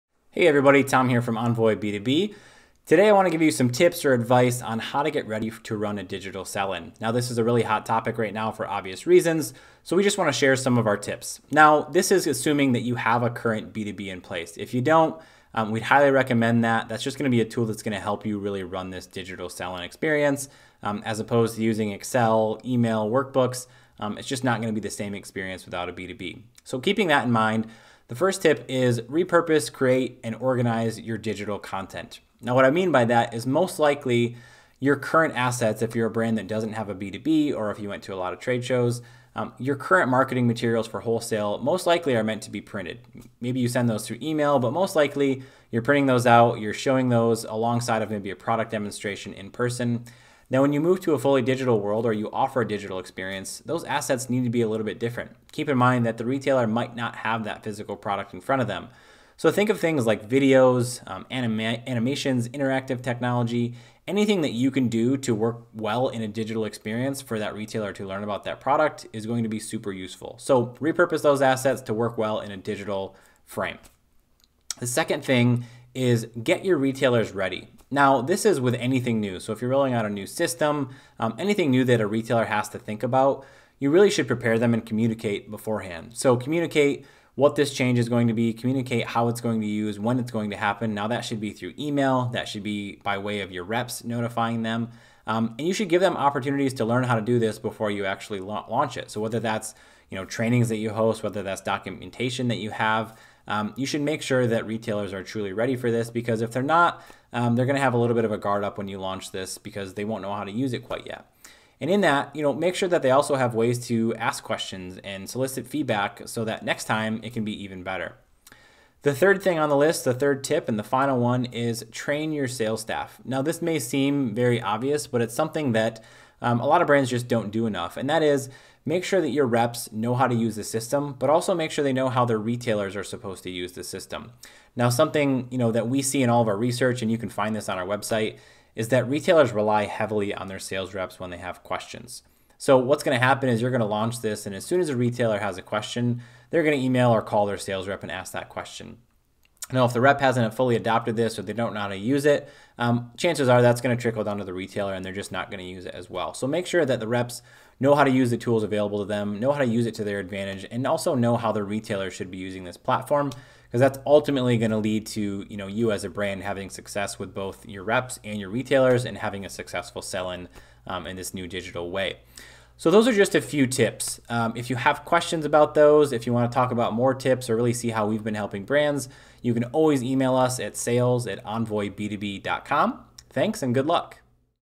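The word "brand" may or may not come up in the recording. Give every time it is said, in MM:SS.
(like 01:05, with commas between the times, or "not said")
00:36, 02:06, 02:46, 02:58.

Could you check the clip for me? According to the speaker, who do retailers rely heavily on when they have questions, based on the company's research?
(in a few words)
Sales reps.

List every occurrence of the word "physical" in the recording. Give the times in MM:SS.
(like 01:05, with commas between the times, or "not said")
00:57.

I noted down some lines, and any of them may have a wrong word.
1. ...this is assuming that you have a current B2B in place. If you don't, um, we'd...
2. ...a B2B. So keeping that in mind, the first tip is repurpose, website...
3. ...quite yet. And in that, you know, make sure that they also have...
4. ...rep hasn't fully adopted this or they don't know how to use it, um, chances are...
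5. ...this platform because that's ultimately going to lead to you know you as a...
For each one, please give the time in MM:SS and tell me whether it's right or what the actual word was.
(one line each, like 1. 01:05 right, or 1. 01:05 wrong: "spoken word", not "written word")
1. 00:11 right
2. 00:25 wrong: "create", not "website"
3. 01:50 right
4. 02:30 right
5. 02:42 right.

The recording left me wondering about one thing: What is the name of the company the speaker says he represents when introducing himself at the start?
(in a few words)
Envoy B2B.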